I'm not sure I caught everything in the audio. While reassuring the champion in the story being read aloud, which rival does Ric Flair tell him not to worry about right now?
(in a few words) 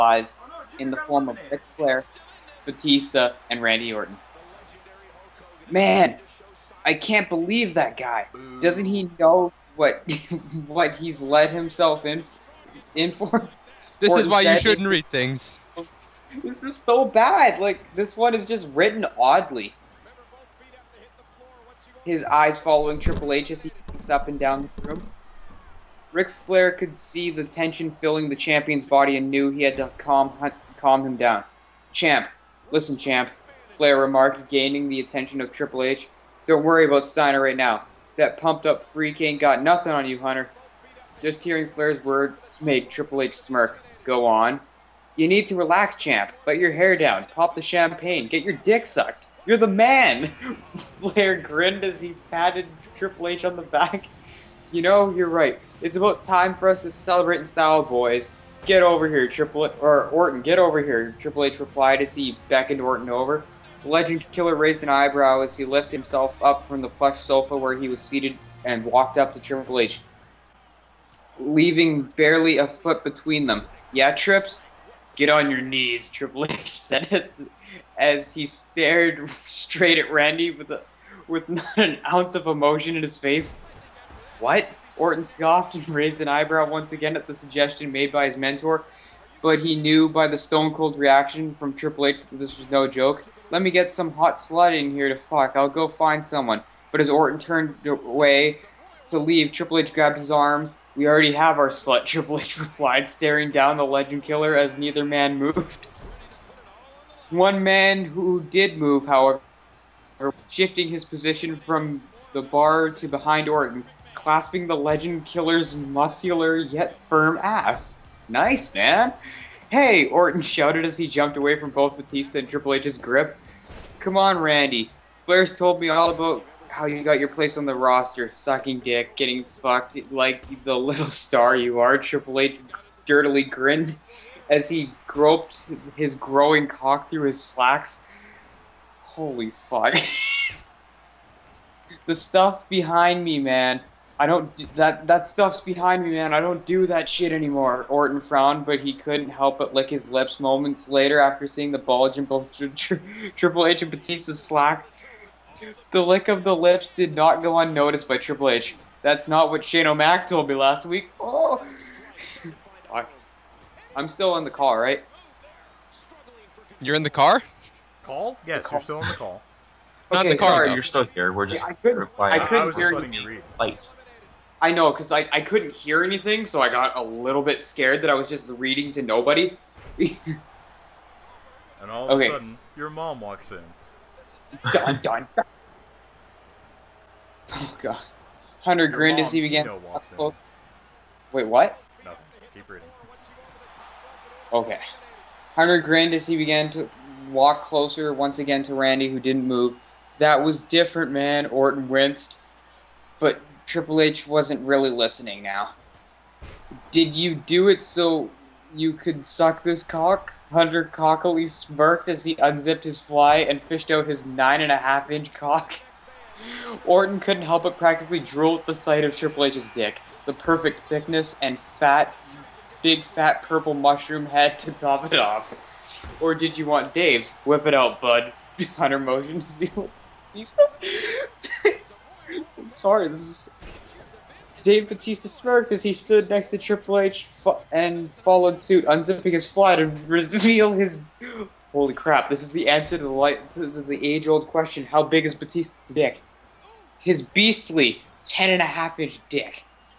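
Steiner.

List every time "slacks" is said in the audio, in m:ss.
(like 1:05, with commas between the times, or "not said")
2:17, 2:34.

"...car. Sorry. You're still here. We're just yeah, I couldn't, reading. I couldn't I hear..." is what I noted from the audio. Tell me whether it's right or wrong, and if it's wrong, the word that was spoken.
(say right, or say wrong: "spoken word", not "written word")
wrong: "replying", not "reading".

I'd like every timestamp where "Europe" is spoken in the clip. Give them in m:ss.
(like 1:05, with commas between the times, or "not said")
not said.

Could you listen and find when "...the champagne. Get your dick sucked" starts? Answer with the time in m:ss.
0:47.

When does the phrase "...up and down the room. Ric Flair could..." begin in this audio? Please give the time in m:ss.
0:24.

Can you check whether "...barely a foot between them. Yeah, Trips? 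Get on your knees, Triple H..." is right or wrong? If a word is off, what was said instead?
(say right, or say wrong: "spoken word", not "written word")
right.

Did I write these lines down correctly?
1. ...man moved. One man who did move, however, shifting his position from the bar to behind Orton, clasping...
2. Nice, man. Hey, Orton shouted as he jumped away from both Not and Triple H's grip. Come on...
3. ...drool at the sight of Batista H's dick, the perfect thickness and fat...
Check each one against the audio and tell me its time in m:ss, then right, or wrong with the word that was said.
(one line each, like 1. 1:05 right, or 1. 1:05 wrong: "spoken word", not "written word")
1. 1:45 right
2. 1:58 wrong: "Batista", not "Not"
3. 3:38 wrong: "Triple", not "Batista".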